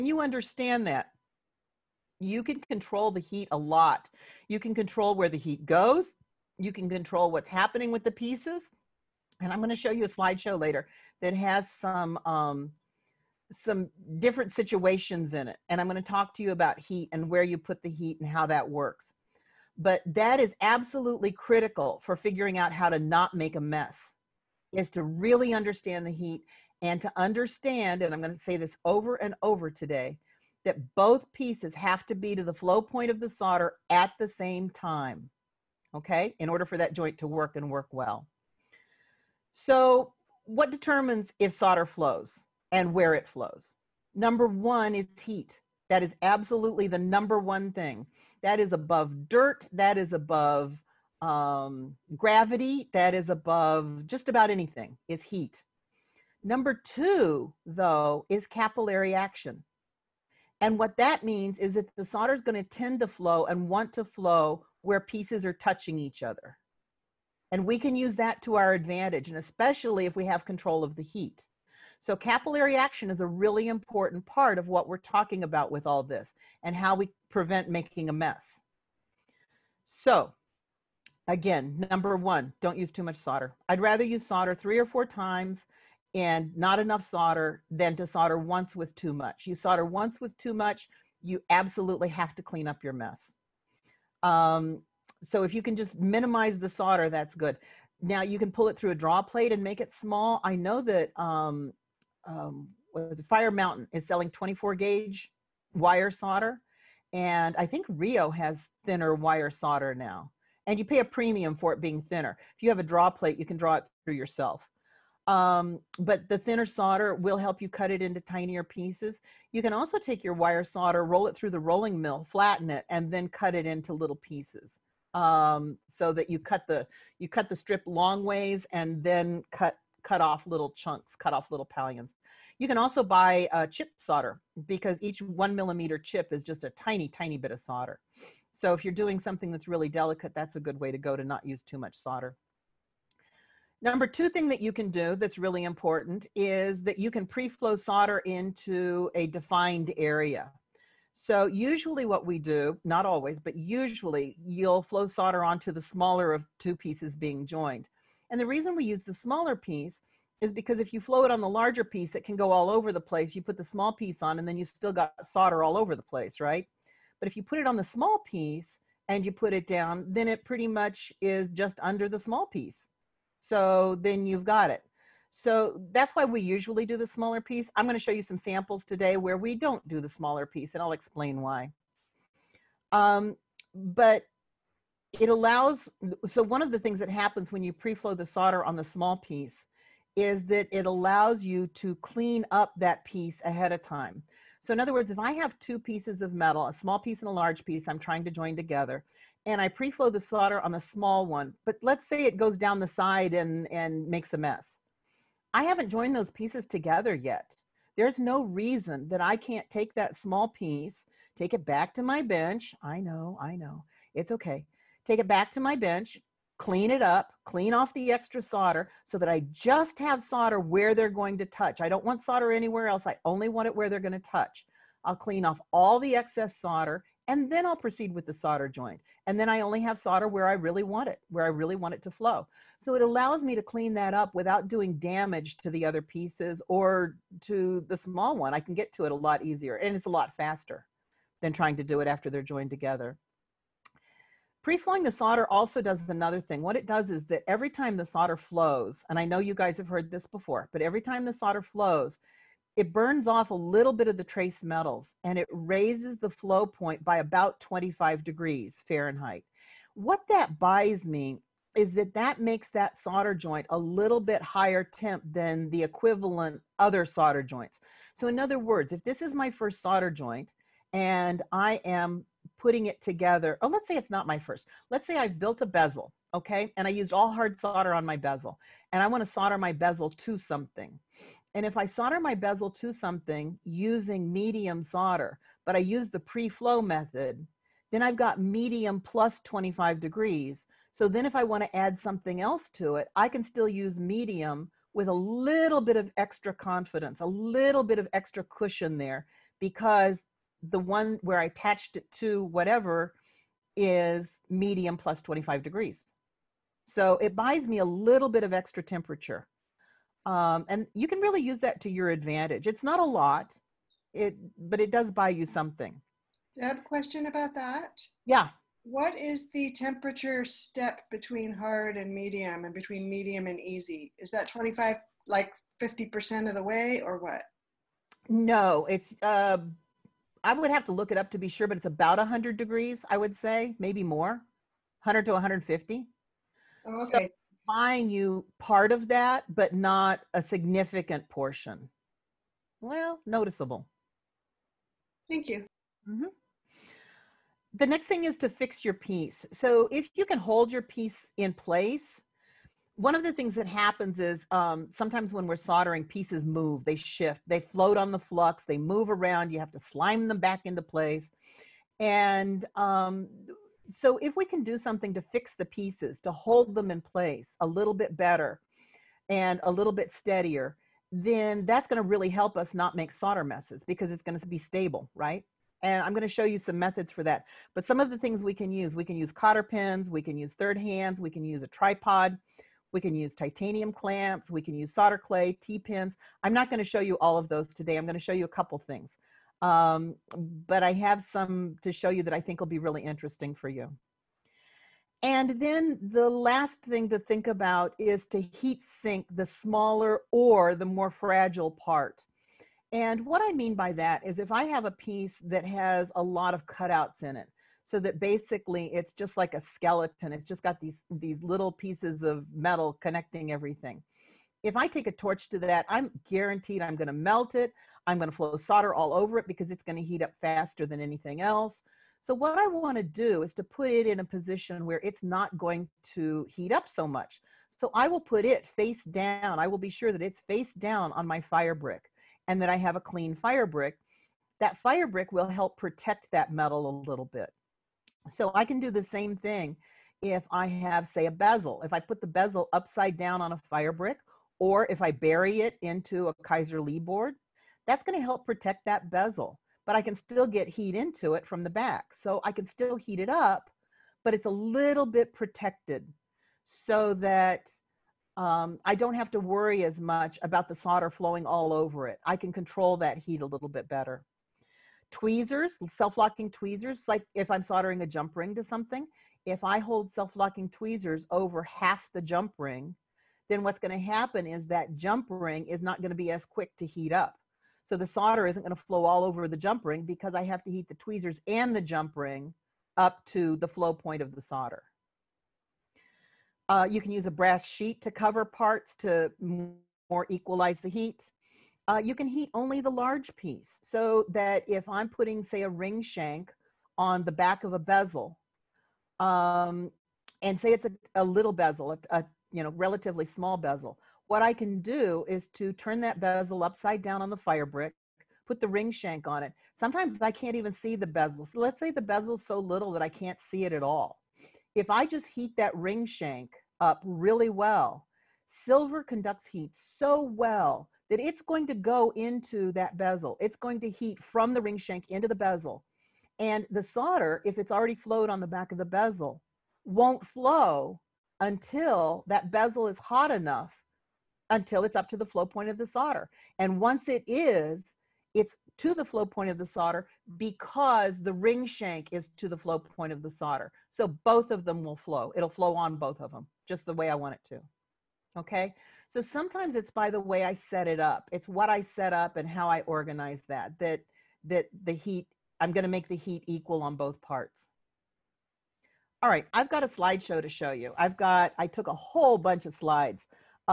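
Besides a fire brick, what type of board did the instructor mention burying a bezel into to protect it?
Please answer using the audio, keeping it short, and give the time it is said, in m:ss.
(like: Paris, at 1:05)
Kaiser Lee board, at 7:26.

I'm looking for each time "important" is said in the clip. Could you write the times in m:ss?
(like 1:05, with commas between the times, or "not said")
1:13, 2:25.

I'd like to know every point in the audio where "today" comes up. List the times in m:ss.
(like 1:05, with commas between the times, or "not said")
0:29, 2:58, 6:27.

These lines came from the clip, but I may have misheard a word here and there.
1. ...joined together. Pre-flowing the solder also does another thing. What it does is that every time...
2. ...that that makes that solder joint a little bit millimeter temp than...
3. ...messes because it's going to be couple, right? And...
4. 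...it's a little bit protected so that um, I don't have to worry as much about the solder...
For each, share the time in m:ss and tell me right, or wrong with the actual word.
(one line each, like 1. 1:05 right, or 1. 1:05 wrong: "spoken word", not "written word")
1. 4:02 right
2. 4:21 wrong: "higher", not "millimeter"
3. 6:13 wrong: "stable", not "couple"
4. 7:34 right.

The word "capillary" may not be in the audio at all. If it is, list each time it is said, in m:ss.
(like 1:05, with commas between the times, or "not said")
0:58, 1:12.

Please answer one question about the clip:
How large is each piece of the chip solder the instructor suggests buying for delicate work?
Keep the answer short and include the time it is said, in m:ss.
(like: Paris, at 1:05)
1 millimeter, at 2:15.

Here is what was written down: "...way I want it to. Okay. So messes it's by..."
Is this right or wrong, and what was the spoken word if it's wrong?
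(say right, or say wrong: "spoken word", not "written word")
wrong: "sometimes", not "messes".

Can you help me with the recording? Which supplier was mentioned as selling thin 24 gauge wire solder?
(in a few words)
Fire Mountain.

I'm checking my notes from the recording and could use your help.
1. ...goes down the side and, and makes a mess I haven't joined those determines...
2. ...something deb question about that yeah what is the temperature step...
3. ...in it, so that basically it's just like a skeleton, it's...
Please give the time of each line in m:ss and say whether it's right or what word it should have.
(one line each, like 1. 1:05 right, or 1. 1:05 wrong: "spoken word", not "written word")
1. 3:22 wrong: "pieces", not "determines"
2. 5:15 right
3. 6:47 right.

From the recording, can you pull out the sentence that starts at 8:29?
Sometimes I can't even see the bezel.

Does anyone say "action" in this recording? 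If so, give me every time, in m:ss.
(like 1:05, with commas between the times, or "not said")
0:59, 1:12.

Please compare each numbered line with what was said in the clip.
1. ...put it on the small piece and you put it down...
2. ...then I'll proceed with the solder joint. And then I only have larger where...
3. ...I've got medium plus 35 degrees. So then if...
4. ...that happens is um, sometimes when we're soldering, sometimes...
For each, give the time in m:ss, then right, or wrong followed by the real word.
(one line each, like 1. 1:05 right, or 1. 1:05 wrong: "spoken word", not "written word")
1. 2:47 right
2. 3:47 wrong: "solder", not "larger"
3. 4:48 wrong: "25", not "35"
4. 5:53 wrong: "pieces", not "sometimes".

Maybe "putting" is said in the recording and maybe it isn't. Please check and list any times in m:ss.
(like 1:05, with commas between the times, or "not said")
4:32, 8:15.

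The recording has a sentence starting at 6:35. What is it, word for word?
And then the last thing to think about is to heat sink the smaller or the more fragile part.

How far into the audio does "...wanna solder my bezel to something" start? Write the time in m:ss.
4:39.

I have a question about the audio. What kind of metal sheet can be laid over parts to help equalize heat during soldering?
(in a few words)
Brass sheet.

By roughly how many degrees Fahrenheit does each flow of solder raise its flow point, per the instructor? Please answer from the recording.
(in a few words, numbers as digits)
25 degrees.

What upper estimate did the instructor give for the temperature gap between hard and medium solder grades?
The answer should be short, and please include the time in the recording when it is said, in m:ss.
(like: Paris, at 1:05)
150 degrees, at 5:35.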